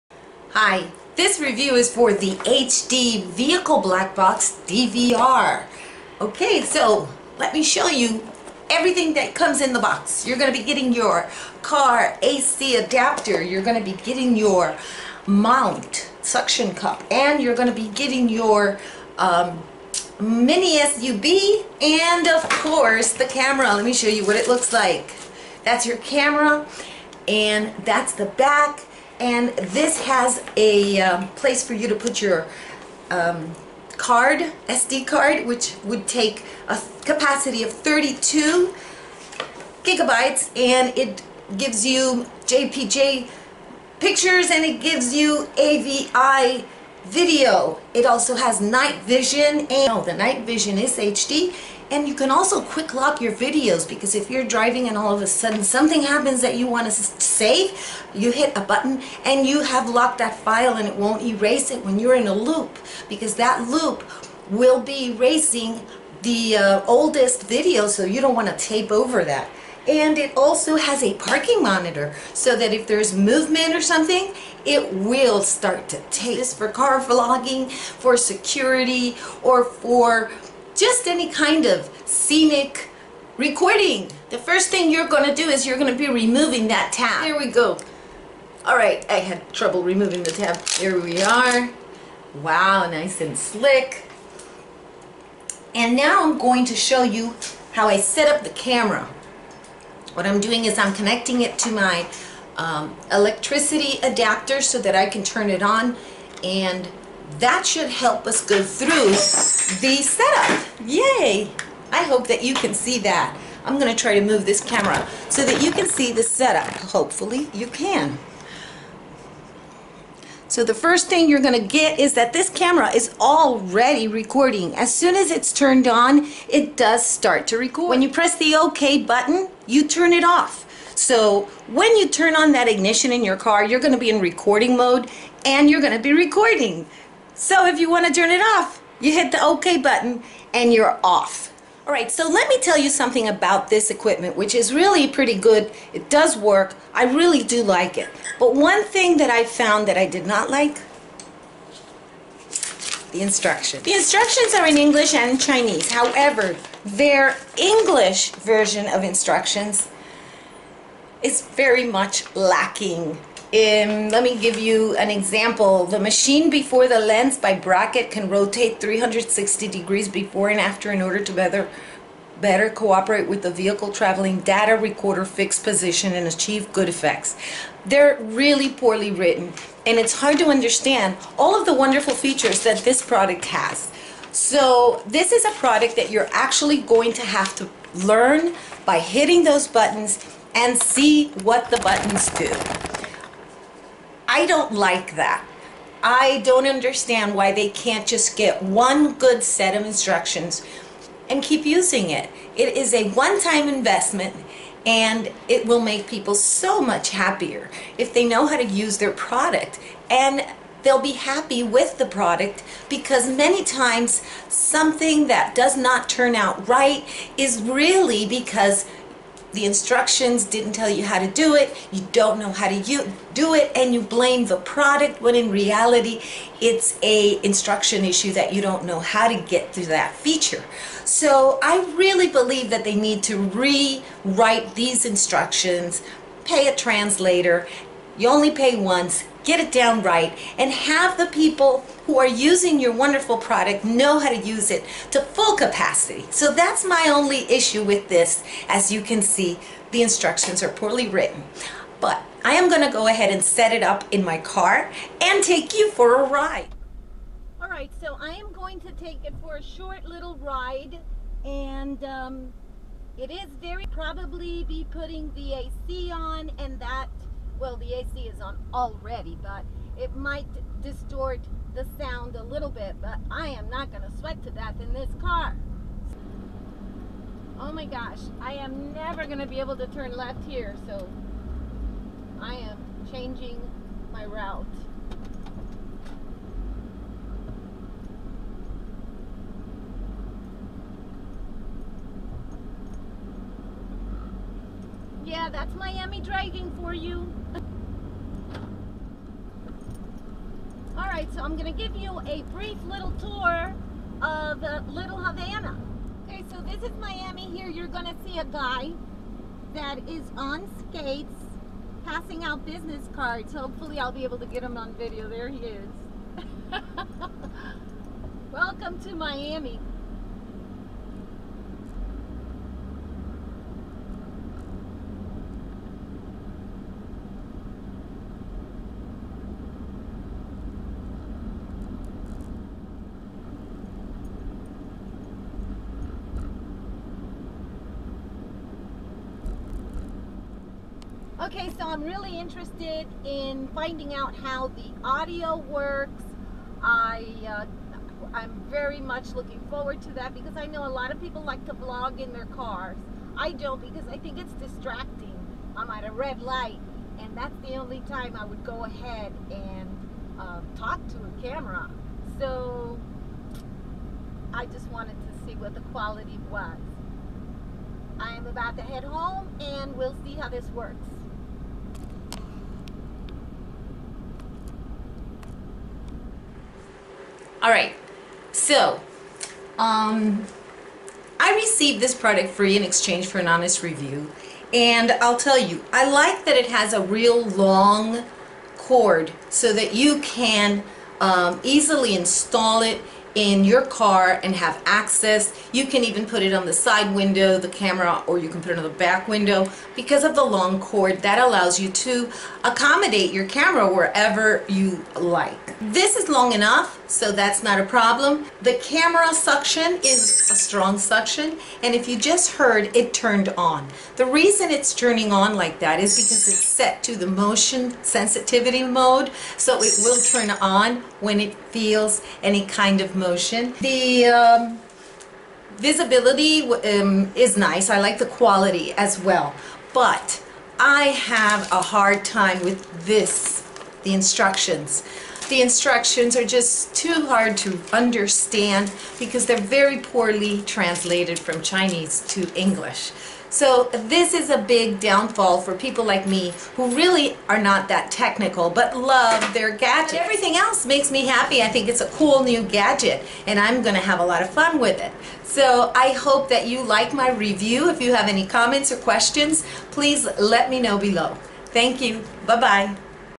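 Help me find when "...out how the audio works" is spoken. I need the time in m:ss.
5:44.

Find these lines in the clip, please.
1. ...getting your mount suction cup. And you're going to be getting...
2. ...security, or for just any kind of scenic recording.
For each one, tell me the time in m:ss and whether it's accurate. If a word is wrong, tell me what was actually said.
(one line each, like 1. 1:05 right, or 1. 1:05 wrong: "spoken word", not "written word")
1. 0:14 right
2. 1:18 right.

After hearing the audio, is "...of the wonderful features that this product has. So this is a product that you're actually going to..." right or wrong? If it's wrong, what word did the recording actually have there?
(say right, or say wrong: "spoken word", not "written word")
right.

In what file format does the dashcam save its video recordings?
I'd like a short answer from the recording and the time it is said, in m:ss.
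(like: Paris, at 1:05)
AVI, at 0:45.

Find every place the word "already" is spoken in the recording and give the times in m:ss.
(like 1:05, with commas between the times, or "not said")
2:03, 4:28.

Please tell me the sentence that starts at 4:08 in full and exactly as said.
As you can see, the instructions are poorly written.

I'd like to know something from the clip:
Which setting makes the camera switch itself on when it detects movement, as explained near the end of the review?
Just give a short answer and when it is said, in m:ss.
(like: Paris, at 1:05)
Motion sensitivity mode, at 6:57.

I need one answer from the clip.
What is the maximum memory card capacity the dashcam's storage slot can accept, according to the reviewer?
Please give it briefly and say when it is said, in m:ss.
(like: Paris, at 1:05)
32 gigabytes, at 0:37.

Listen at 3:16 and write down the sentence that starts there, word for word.
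I don't understand why they can't just get one good set of instructions and keep using it.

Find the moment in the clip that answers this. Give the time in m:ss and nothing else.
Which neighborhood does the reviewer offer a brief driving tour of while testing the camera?
5:04.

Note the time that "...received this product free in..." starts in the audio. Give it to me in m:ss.
6:21.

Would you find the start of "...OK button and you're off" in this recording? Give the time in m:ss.
2:19.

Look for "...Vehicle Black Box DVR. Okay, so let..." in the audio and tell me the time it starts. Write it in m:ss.
0:03.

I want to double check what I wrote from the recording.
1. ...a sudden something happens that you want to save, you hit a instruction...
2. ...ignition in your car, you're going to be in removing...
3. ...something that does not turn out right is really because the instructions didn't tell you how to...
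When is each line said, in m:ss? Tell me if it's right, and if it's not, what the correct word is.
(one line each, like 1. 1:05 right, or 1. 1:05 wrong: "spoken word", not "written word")
1. 0:55 wrong: "button", not "instruction"
2. 2:12 wrong: "recording", not "removing"
3. 3:34 right.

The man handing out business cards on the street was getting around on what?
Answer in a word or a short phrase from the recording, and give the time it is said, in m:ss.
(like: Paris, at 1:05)
Skates, at 5:10.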